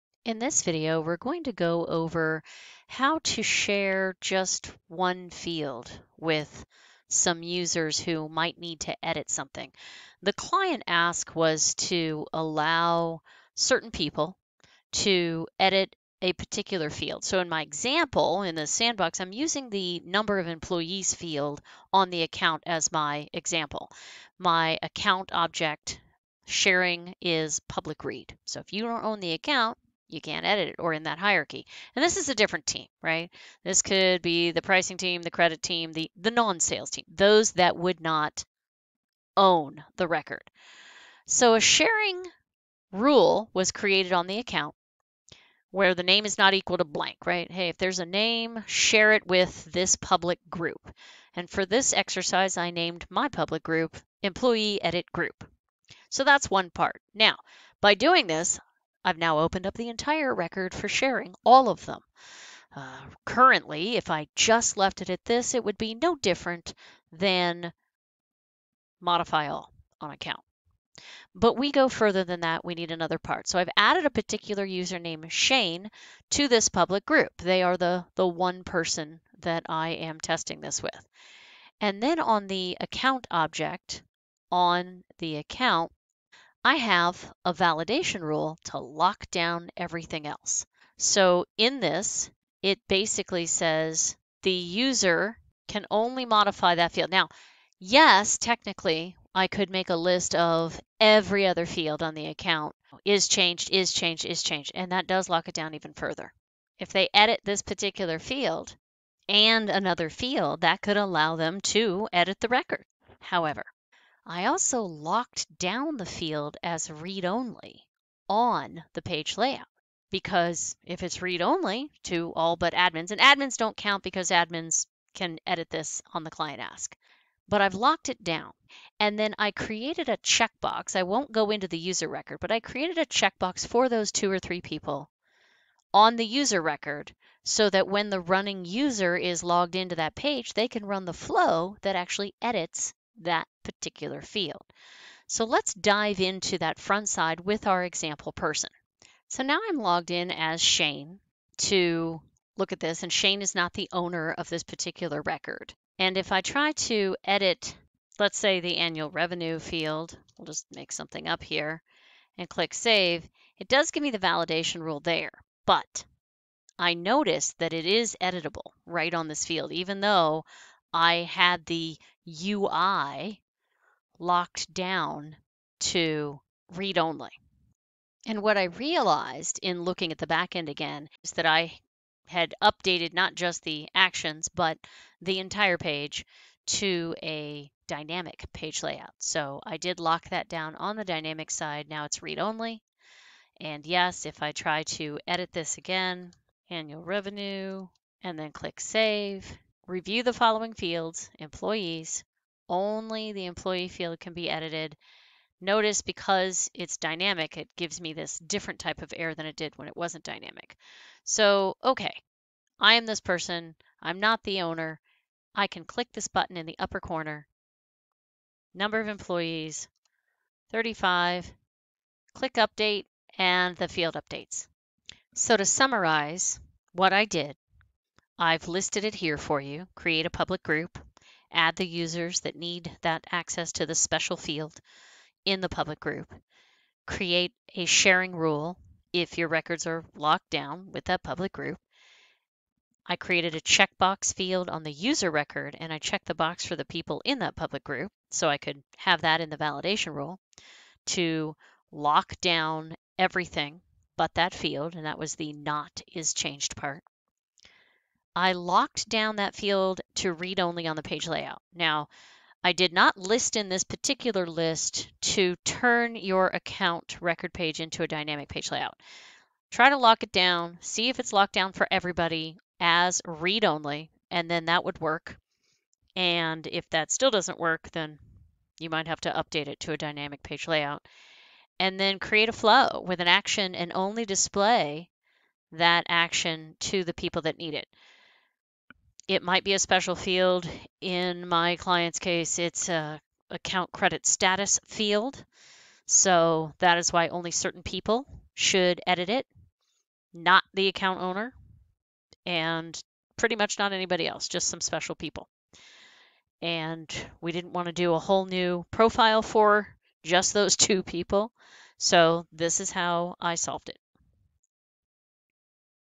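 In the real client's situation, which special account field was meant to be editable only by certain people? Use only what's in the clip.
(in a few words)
Account credit status.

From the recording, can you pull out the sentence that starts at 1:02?
Uh, currently, if I just left it at this, it would be no different than modify all on account.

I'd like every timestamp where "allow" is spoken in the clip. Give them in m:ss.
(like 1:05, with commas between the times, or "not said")
0:12, 1:50.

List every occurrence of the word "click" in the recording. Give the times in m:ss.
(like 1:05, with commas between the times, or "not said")
2:42, 3:18, 3:35, 3:42.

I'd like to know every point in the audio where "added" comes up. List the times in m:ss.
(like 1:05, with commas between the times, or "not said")
1:13.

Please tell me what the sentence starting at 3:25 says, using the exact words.
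Notice because it's dynamic, it gives me this different type of error than it did when it wasn't dynamic.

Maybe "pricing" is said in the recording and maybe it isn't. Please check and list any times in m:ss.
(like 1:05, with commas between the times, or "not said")
0:34.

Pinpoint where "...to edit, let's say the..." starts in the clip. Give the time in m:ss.
2:36.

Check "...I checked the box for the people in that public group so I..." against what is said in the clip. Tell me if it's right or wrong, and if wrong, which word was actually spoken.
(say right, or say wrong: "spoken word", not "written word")
right.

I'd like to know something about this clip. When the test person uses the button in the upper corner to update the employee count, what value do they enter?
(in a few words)
35.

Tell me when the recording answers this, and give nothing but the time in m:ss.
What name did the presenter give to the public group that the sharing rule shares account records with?
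0:54.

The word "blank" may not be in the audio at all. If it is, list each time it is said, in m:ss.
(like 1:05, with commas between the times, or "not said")
0:46.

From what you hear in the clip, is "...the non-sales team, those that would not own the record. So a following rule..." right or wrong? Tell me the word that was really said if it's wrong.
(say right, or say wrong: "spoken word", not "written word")
wrong: "sharing", not "following".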